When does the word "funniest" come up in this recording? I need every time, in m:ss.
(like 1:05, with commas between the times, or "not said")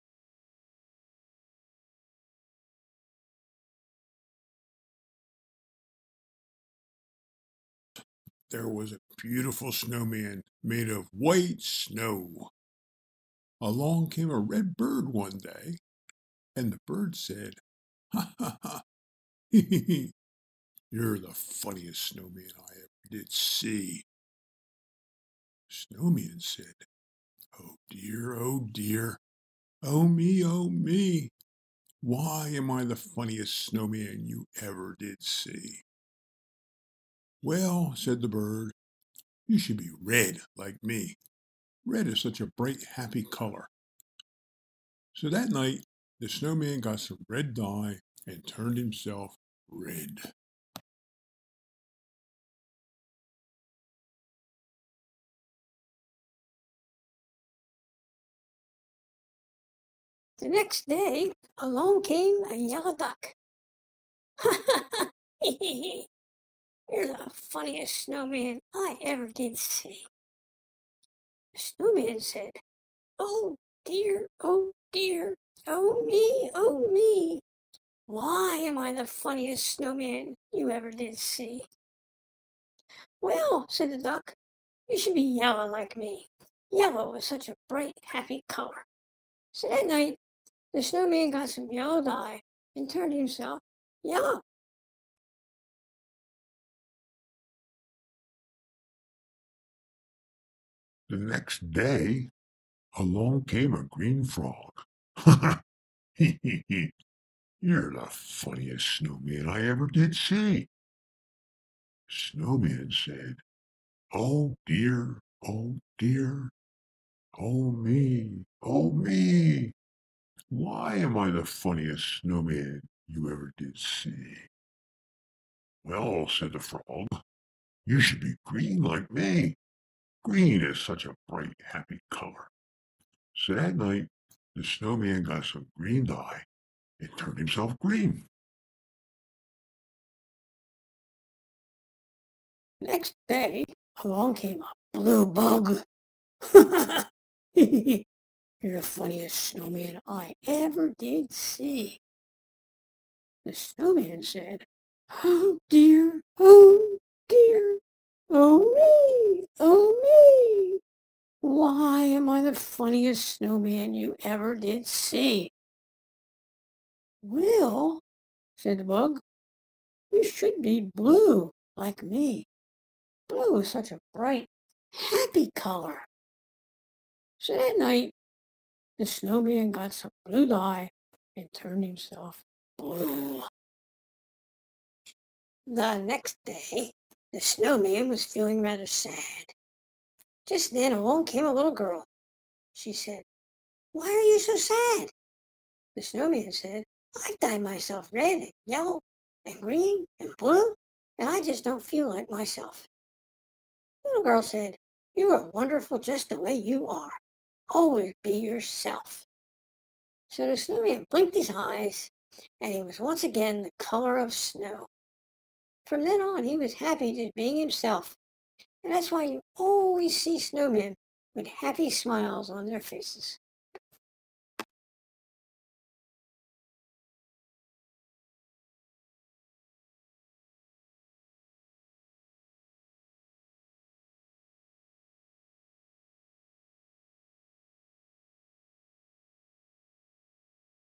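0:21, 0:32, 1:07, 1:19, 1:48, 2:01, 2:28, 2:42.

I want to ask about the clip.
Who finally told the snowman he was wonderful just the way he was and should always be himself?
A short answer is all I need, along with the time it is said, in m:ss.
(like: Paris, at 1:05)
A little girl, at 3:11.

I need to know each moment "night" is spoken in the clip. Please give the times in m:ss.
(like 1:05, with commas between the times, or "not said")
0:45, 1:29, 2:13, 2:57.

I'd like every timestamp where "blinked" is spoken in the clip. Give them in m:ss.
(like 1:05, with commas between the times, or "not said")
3:31.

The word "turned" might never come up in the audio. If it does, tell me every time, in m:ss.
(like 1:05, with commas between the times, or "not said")
0:48, 1:32, 2:17, 3:01.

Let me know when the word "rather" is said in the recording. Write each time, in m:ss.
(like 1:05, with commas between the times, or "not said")
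3:08.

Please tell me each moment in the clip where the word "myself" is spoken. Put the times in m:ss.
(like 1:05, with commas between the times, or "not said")
3:17, 3:22.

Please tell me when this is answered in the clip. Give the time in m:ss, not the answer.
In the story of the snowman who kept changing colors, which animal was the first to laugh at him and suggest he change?
0:14.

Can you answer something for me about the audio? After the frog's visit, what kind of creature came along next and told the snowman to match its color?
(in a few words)
Blue bug.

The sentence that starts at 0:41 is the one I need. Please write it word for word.
Red is such a bright, happy color.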